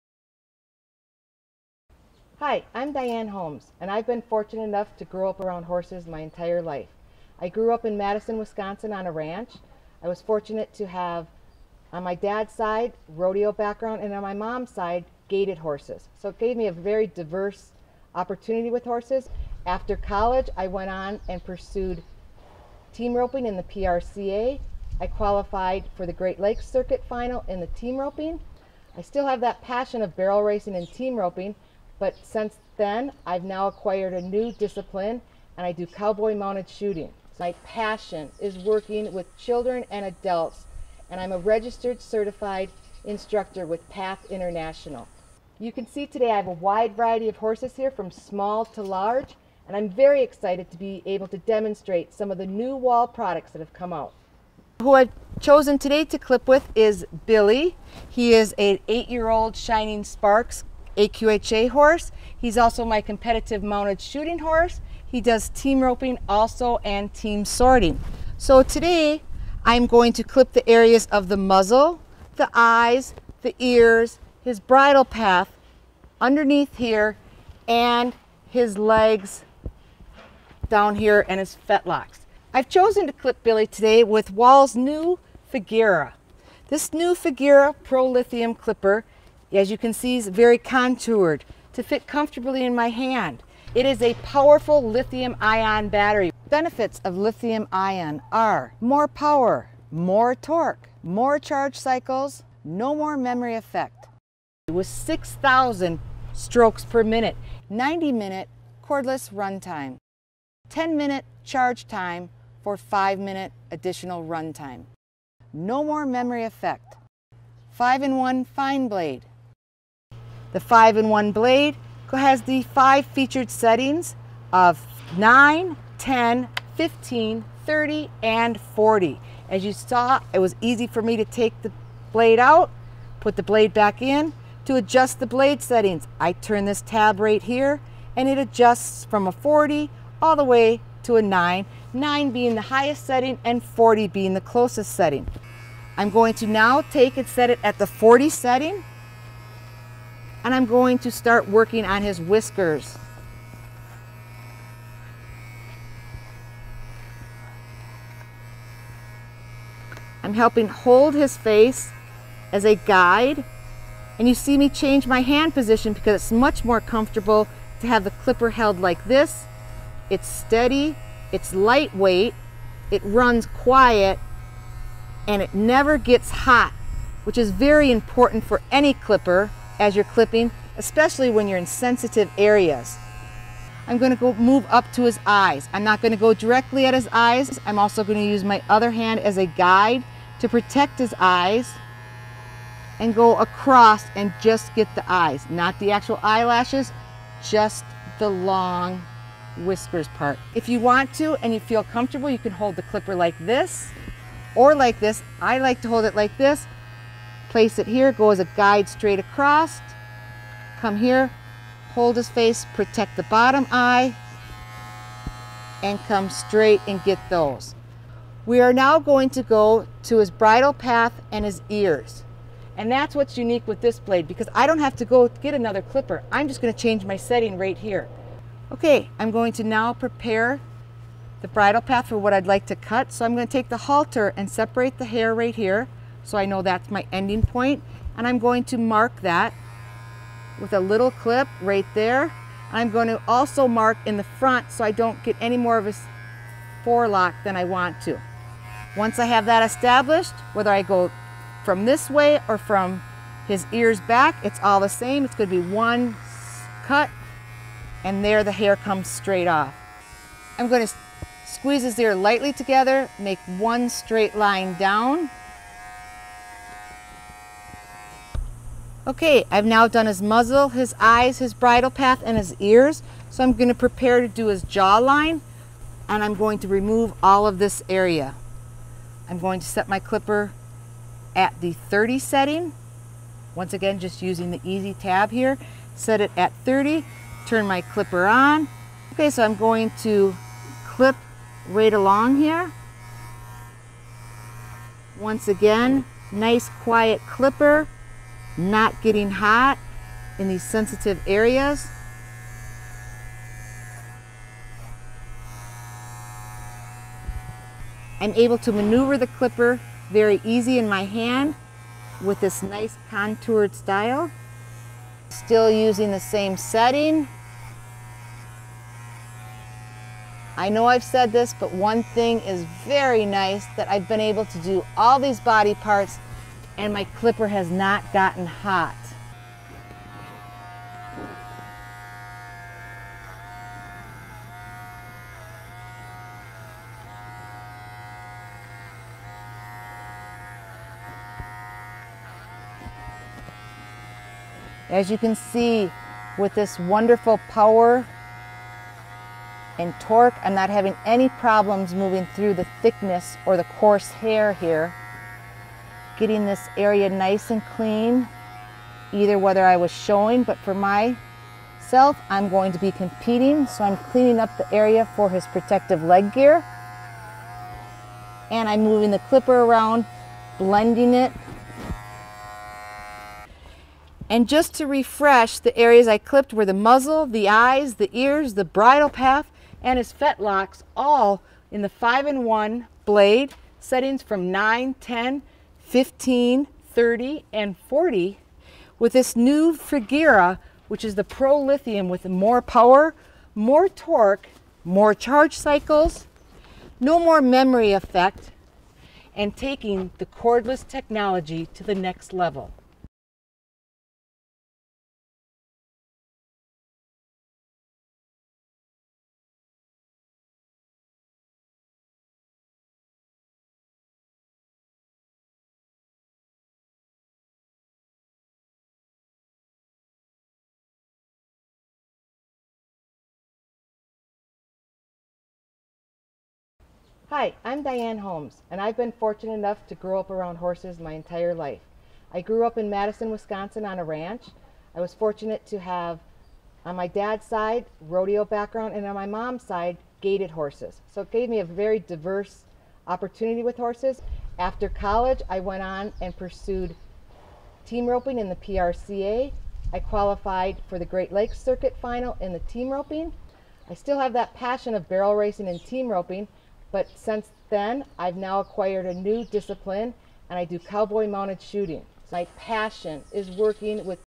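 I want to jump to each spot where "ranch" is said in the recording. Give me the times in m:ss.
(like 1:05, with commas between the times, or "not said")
0:09, 7:14.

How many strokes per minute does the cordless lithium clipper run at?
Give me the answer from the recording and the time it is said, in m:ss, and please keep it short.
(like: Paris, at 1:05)
6,000, at 1:44.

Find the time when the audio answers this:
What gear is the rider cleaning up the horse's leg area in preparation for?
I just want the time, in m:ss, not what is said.
6:05.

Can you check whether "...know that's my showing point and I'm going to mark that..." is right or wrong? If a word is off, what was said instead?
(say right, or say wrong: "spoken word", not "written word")
wrong: "ending", not "showing".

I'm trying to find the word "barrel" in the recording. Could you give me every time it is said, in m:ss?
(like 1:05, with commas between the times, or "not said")
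0:30, 7:35.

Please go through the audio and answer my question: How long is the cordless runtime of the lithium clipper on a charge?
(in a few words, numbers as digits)
90 minutes.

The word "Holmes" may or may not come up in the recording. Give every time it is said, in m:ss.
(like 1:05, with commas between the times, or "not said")
0:03, 7:08.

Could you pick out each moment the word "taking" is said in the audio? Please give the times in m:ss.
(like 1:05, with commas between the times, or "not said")
6:39.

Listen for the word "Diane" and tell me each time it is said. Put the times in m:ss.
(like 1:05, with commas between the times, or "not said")
0:02, 7:07.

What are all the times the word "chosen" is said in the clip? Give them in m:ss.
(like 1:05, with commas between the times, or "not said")
0:55, 1:22.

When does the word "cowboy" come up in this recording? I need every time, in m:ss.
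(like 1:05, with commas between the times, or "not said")
0:35, 7:40.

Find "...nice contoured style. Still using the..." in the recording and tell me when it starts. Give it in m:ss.
5:12.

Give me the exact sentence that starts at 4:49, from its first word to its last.
Okay, so I'm going to clip right along here.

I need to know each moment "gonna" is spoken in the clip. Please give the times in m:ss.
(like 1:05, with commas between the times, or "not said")
3:46, 3:53, 4:33.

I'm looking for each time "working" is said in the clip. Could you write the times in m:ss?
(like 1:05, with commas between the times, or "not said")
0:38, 2:31, 7:43.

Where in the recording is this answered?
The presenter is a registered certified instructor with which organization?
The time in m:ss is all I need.
0:43.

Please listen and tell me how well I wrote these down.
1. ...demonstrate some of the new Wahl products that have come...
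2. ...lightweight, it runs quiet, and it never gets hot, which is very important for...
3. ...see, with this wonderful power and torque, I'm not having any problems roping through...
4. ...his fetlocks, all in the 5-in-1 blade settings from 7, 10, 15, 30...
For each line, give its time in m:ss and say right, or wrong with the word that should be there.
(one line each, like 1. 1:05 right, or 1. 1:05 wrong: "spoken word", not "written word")
1. 0:51 right
2. 2:51 right
3. 5:45 wrong: "moving", not "roping"
4. 6:19 wrong: "9", not "7".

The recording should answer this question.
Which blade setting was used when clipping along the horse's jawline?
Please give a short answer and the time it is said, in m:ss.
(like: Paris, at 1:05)
30, at 4:41.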